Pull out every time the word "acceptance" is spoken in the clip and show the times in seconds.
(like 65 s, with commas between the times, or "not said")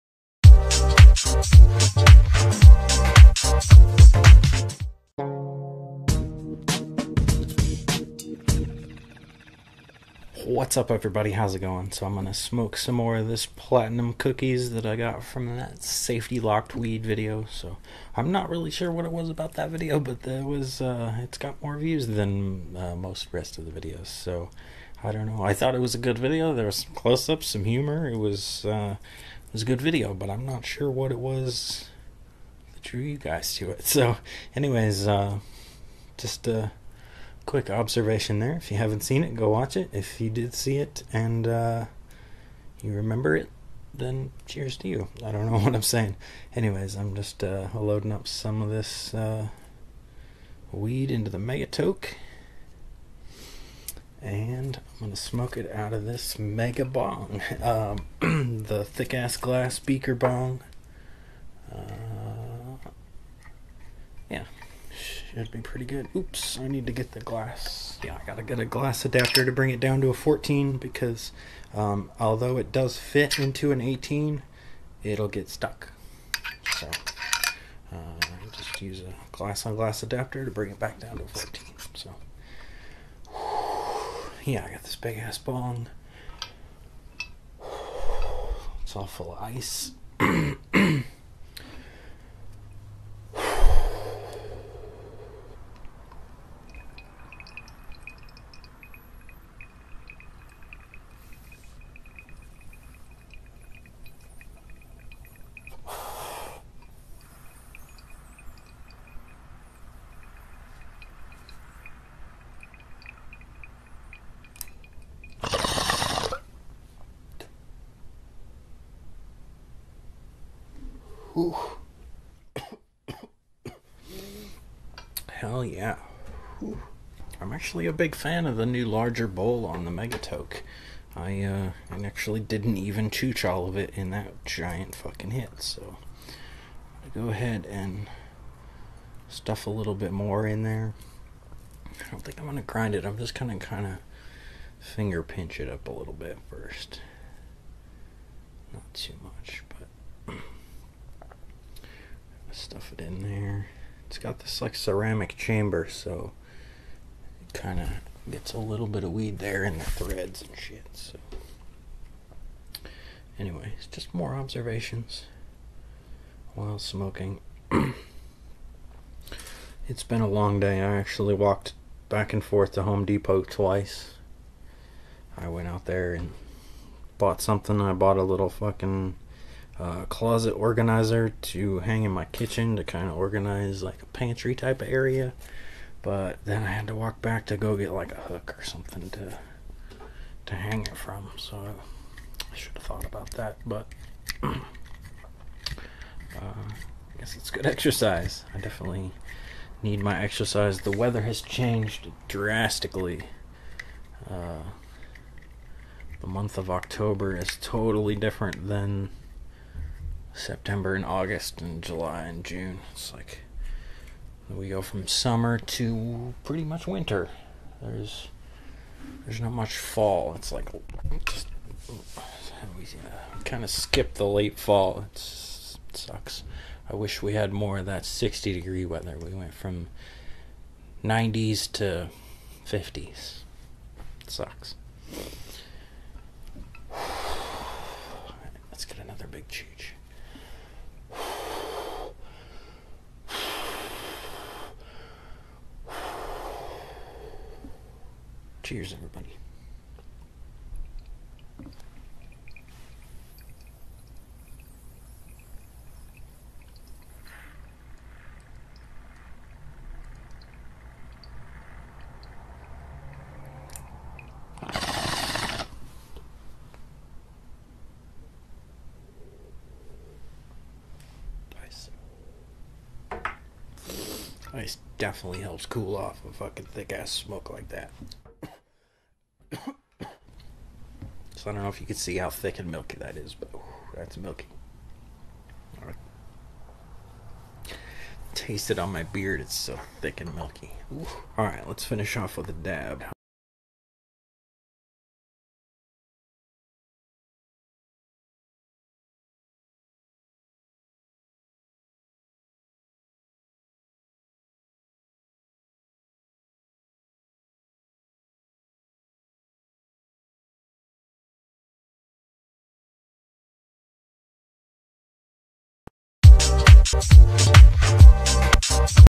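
not said.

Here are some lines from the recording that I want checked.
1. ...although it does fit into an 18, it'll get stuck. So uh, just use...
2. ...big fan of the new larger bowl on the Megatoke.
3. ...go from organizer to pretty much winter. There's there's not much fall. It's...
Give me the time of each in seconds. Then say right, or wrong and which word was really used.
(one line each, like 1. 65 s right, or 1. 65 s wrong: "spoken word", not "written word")
1. 72 s right
2. 127 s right
3. 214 s wrong: "summer", not "organizer".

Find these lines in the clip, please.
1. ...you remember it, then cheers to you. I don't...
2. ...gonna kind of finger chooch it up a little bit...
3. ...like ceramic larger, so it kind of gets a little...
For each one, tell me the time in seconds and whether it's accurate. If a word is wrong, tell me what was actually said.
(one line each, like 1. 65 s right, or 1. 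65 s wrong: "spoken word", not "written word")
1. 42 s right
2. 143 s wrong: "pinch", not "chooch"
3. 154 s wrong: "chamber", not "larger".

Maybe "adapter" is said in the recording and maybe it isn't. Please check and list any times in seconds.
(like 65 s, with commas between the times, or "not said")
69 s, 80 s.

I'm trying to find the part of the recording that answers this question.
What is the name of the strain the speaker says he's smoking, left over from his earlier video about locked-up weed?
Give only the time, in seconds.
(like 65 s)
13 s.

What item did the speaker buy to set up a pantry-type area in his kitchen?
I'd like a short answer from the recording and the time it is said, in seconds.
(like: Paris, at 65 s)
closet organizer, at 180 s.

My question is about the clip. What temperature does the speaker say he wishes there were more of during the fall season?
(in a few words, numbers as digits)
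60 degrees.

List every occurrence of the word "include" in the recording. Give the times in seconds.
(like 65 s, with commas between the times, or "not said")
not said.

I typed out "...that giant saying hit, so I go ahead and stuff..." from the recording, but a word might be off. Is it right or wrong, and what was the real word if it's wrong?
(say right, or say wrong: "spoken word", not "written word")
wrong: "fucking", not "saying".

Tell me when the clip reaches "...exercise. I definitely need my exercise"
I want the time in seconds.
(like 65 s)
197 s.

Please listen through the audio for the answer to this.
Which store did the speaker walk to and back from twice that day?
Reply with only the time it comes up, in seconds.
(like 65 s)
172 s.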